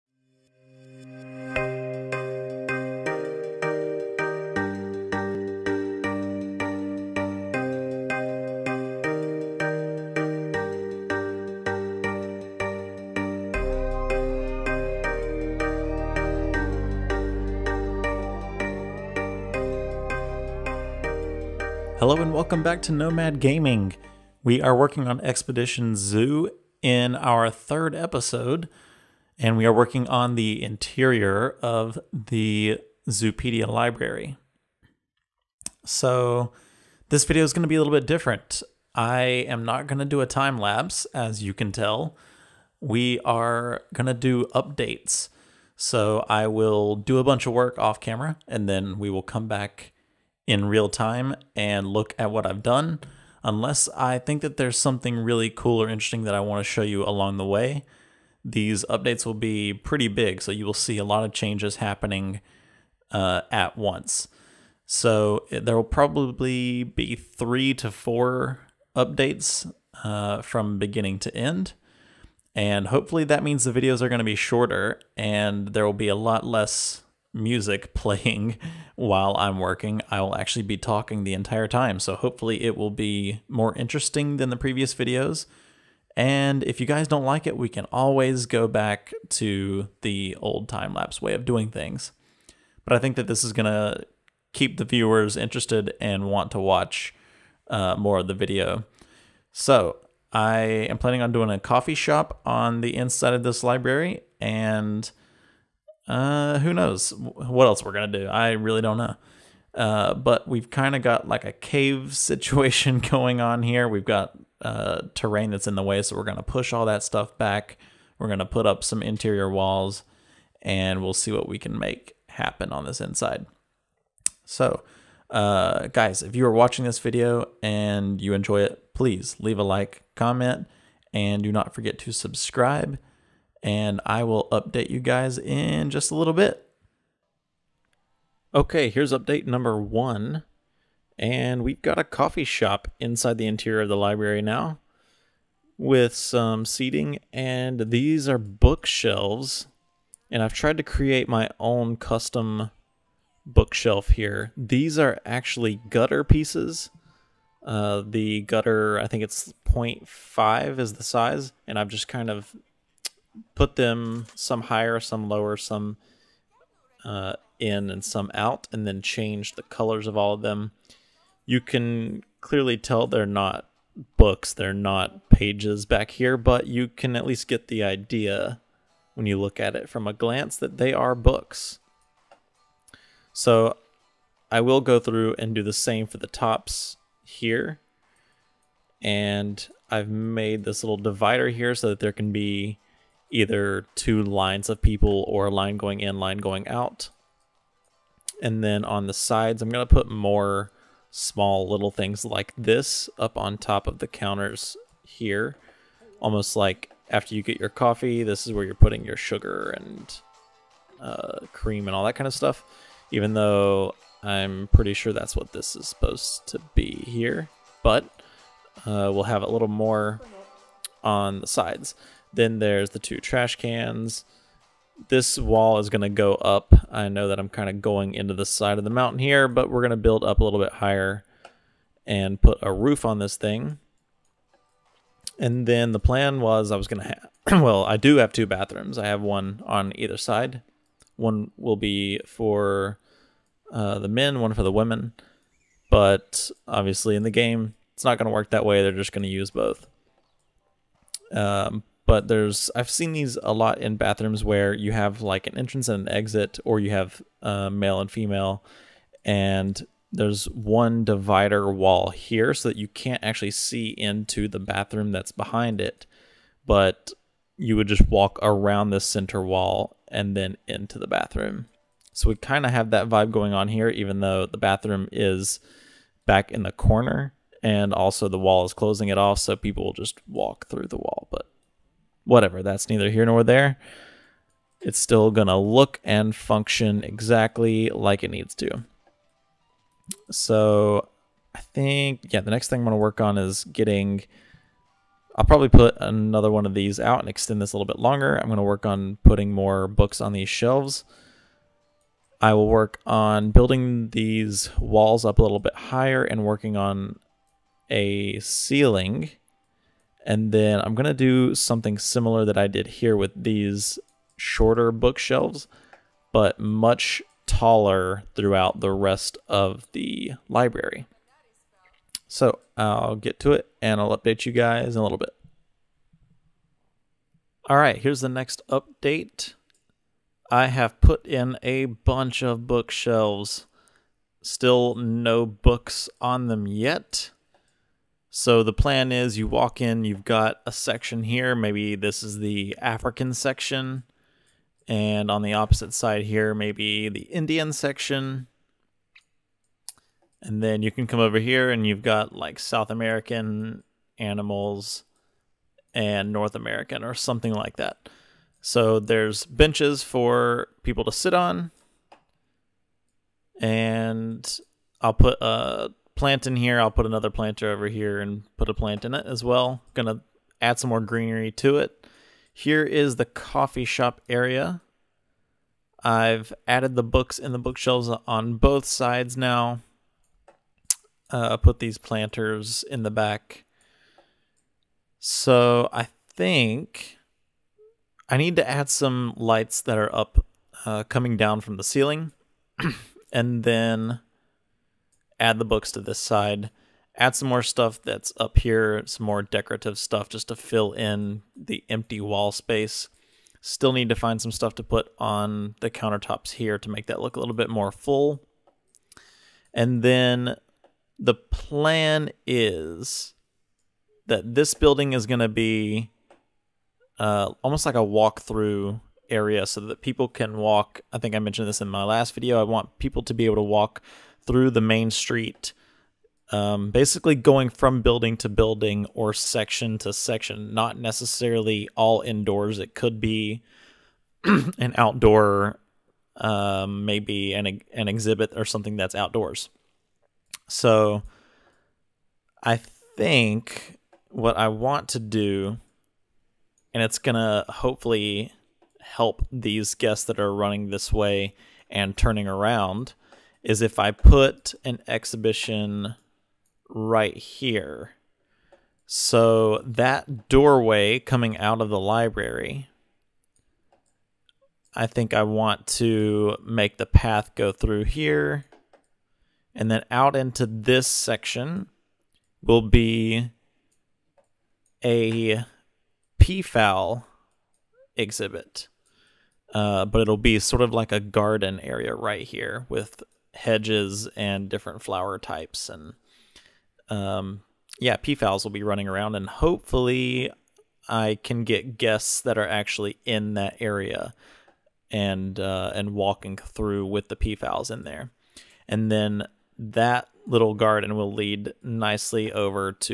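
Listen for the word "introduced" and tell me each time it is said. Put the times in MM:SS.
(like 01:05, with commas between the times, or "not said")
not said.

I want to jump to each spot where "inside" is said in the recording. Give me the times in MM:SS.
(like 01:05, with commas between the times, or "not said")
01:42, 02:02, 02:22.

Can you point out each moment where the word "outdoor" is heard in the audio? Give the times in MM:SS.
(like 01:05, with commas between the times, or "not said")
07:14, 07:19.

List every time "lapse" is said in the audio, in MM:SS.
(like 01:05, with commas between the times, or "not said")
00:40, 01:30.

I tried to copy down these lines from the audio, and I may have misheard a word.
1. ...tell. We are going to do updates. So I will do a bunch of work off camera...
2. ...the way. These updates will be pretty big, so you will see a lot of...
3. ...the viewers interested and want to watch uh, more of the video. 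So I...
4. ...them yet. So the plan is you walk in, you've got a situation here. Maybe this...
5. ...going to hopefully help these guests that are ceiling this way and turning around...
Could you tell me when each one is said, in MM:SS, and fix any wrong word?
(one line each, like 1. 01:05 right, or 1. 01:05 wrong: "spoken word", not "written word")
1. 00:41 right
2. 00:57 right
3. 01:34 right
4. 05:36 wrong: "section", not "situation"
5. 07:27 wrong: "running", not "ceiling".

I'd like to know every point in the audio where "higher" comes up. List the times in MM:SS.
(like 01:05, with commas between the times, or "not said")
02:44, 03:50, 05:05.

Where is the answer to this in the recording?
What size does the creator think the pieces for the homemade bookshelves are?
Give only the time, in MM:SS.
02:39.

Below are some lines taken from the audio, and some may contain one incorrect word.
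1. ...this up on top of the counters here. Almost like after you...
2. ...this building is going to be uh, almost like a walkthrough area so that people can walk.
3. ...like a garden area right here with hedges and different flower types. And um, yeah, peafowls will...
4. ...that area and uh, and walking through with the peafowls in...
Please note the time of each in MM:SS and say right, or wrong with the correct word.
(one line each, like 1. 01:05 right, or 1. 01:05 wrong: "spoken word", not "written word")
1. 03:22 right
2. 06:54 right
3. 08:00 right
4. 08:13 right.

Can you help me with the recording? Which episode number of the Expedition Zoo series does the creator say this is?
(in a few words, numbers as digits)
third.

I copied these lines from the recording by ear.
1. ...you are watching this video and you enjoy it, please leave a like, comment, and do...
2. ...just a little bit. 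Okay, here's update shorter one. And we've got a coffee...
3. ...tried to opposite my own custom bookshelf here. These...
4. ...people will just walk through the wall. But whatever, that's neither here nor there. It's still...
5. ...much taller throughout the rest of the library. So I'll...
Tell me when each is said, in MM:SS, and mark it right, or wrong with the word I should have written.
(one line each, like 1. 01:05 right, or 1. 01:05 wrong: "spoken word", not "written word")
1. 02:06 right
2. 02:15 wrong: "number", not "shorter"
3. 02:30 wrong: "create", not "opposite"
4. 04:39 right
5. 05:16 right.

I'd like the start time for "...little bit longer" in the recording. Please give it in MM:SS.
04:57.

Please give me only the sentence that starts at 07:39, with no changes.
So that doorway coming out of the library, I think I want to make the path go through here.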